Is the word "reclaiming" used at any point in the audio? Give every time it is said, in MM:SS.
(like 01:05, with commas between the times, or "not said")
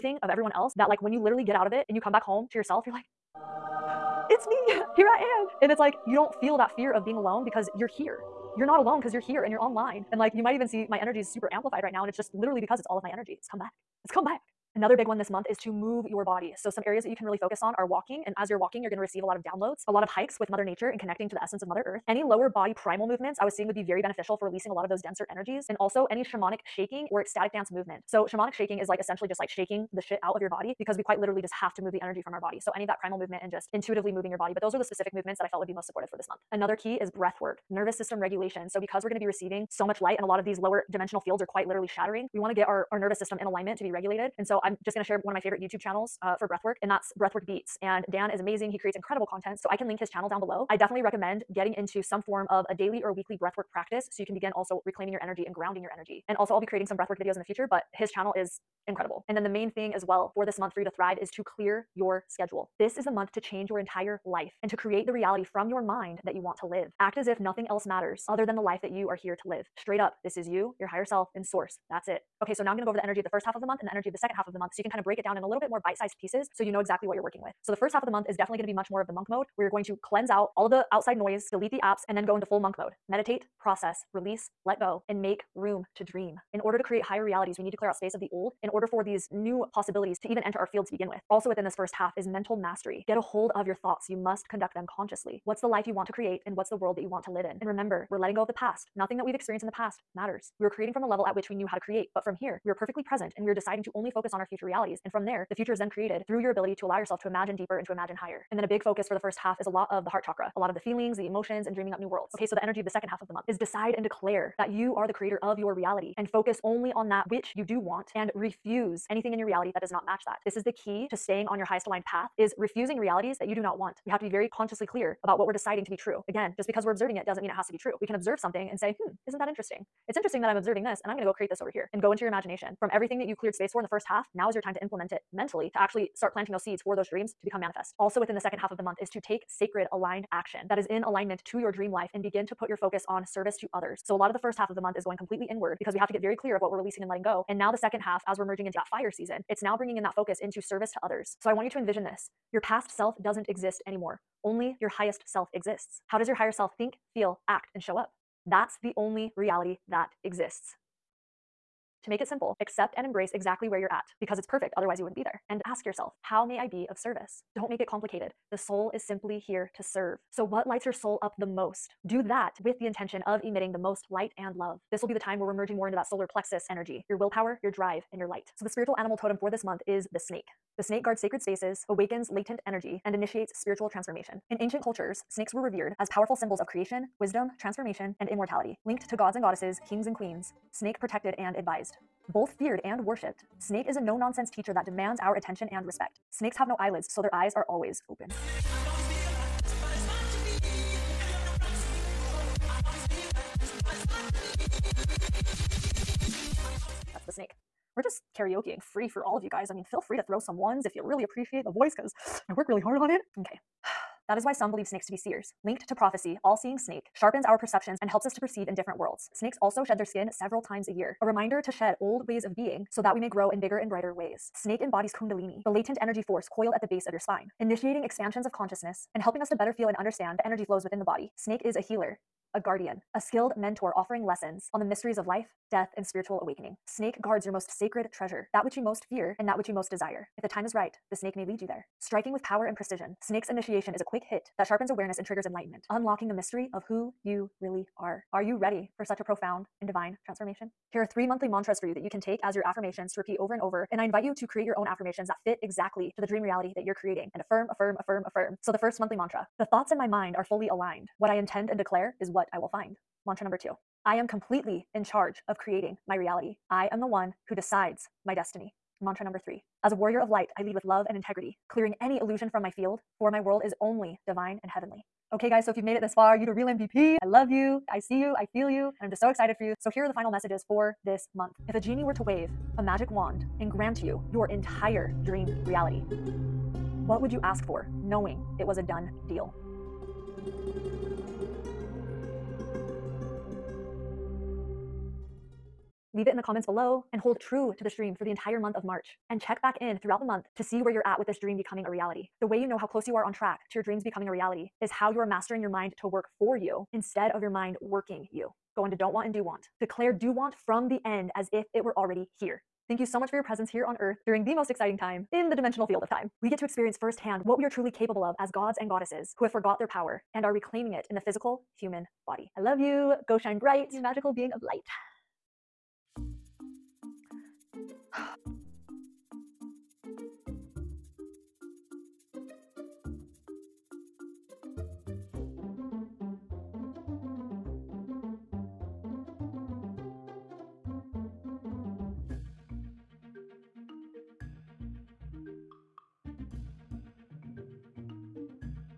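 00:54, 05:20.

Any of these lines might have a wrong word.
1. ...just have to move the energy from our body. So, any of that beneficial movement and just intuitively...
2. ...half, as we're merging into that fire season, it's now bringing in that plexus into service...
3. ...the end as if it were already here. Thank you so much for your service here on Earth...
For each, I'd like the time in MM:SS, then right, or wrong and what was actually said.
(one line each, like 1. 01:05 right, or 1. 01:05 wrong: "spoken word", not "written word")
1. 00:31 wrong: "primal", not "beneficial"
2. 02:27 wrong: "focus", not "plexus"
3. 05:10 wrong: "presence", not "service".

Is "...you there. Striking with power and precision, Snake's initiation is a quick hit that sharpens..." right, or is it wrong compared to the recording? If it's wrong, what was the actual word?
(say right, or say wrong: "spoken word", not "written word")
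right.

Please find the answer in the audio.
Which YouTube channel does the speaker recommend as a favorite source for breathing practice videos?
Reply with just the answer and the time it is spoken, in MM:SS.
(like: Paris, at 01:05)
Breathwork Beats, at 00:47.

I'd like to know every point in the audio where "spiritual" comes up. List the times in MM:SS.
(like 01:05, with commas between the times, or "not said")
02:58, 03:03, 03:56.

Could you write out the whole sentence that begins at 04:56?
Leave it in the comments below and hold true to the stream for the entire month of March.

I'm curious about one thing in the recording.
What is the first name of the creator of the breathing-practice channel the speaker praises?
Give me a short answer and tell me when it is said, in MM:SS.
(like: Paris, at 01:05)
Dan, at 00:48.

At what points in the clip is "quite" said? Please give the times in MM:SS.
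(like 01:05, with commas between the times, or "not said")
00:31, 00:41.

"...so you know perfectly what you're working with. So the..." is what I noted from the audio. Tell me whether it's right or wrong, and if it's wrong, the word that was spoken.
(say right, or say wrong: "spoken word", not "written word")
wrong: "exactly", not "perfectly".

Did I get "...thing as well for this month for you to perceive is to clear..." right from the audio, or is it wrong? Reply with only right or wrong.
wrong.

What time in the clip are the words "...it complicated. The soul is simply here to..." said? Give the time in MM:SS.
02:47.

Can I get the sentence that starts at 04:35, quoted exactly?
Okay, guys, so if you've made it this far, you to real MVP.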